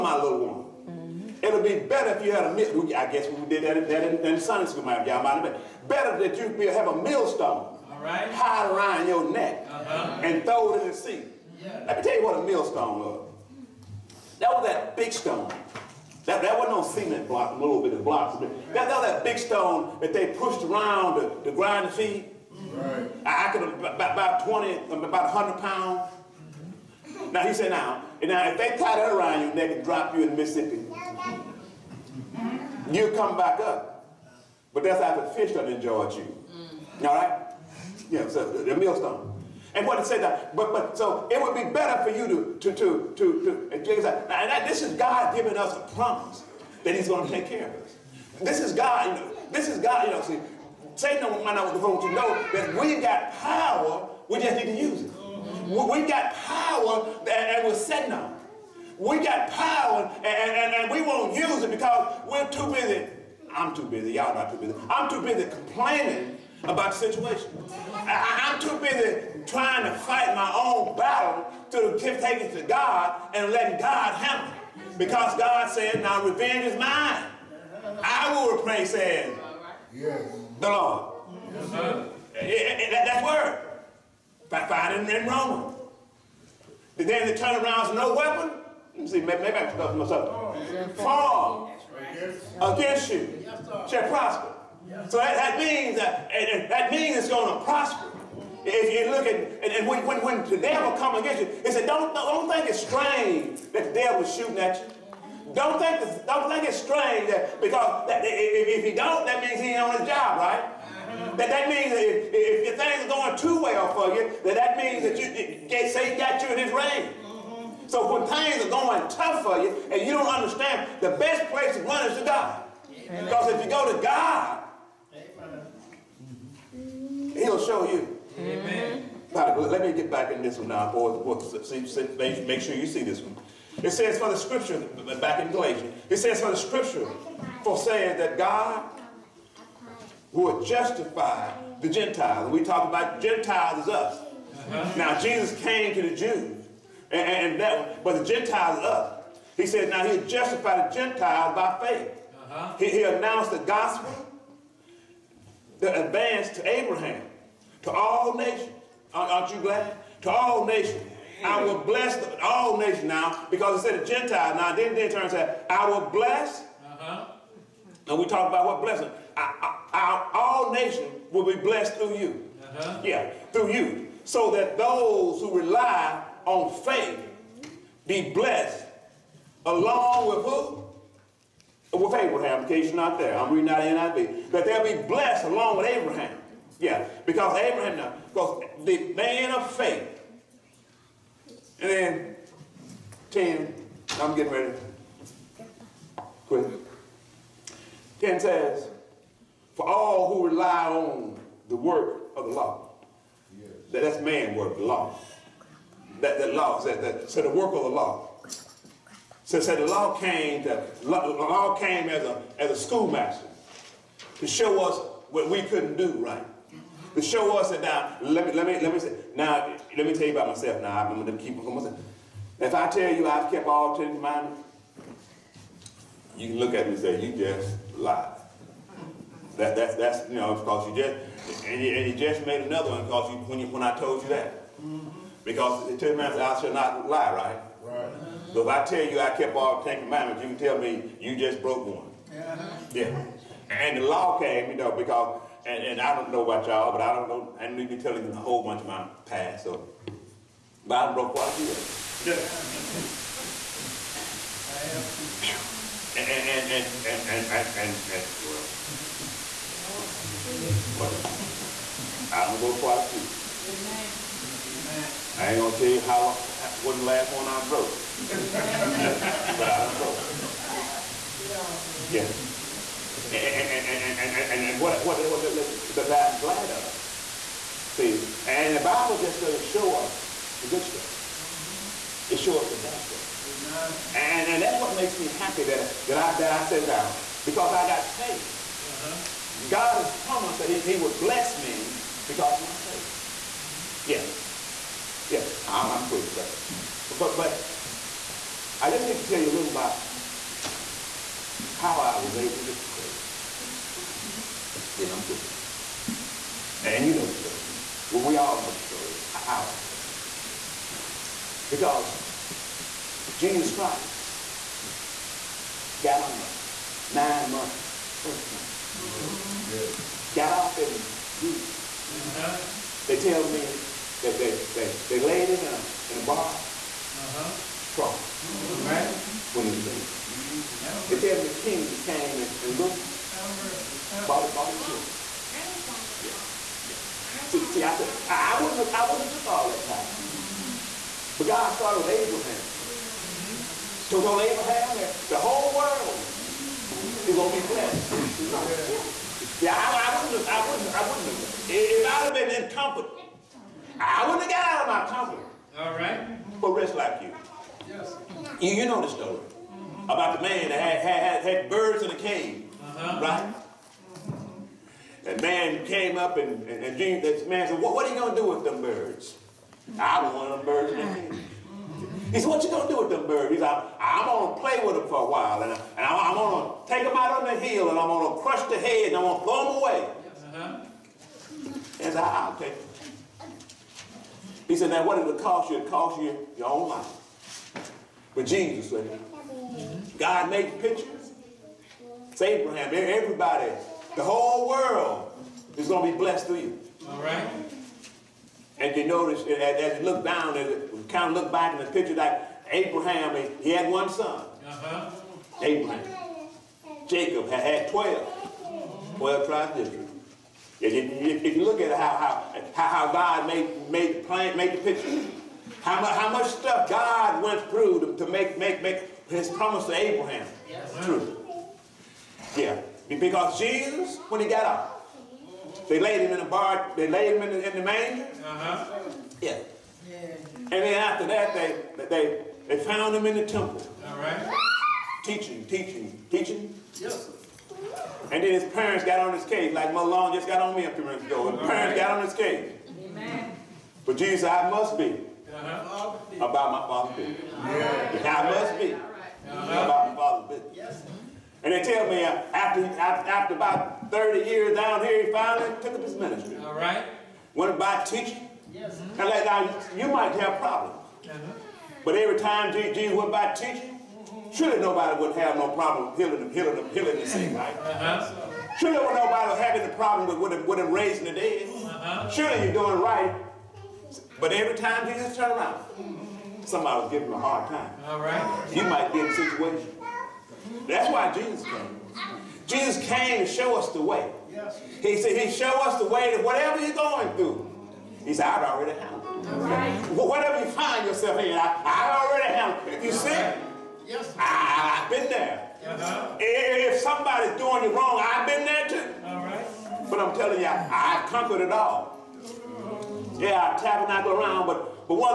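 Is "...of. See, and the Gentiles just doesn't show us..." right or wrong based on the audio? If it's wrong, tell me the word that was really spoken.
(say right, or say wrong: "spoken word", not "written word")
wrong: "Bible", not "Gentiles".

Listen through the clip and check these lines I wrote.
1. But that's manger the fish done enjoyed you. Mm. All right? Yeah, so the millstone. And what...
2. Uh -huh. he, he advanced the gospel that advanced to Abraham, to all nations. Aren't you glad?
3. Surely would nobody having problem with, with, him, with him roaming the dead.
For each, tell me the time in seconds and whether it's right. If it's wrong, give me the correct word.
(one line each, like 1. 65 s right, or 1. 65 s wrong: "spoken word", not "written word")
1. 34 s wrong: "after", not "manger"
2. 152 s wrong: "announced", not "advanced"
3. 468 s wrong: "raising", not "roaming".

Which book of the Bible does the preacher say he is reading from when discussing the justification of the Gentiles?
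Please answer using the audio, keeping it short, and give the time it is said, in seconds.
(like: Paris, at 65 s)
Galatians, at 135 s.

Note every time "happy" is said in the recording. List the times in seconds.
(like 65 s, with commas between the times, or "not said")
285 s.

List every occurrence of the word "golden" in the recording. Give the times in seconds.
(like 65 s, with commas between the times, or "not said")
not said.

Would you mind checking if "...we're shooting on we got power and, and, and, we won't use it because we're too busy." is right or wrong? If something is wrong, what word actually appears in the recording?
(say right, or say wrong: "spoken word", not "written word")
wrong: "sitting", not "shooting".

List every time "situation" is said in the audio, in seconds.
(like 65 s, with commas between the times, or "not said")
67 s, 479 s.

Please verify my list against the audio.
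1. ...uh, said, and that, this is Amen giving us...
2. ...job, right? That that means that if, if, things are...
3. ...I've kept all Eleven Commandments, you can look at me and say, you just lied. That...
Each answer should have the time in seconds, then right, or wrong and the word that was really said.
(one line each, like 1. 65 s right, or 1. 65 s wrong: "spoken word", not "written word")
1. 44 s wrong: "God", not "Amen"
2. 110 s right
3. 223 s wrong: "Ten", not "Eleven".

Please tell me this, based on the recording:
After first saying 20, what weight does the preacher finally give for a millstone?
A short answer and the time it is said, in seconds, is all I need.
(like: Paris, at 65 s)
100 pounds, at 25 s.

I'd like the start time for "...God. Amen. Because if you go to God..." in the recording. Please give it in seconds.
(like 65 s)
122 s.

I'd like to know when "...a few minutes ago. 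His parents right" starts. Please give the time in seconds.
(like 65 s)
440 s.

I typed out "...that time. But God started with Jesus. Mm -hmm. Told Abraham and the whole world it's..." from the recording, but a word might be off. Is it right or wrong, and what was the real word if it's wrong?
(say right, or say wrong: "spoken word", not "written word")
wrong: "Abraham", not "Jesus".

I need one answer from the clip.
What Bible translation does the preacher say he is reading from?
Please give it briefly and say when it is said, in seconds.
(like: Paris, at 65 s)
NIV, at 184 s.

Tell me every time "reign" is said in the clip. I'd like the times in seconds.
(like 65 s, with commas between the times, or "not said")
116 s.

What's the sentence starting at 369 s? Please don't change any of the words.
I want them birds in cave.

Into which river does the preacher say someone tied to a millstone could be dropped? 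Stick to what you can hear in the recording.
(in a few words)
Mississippi.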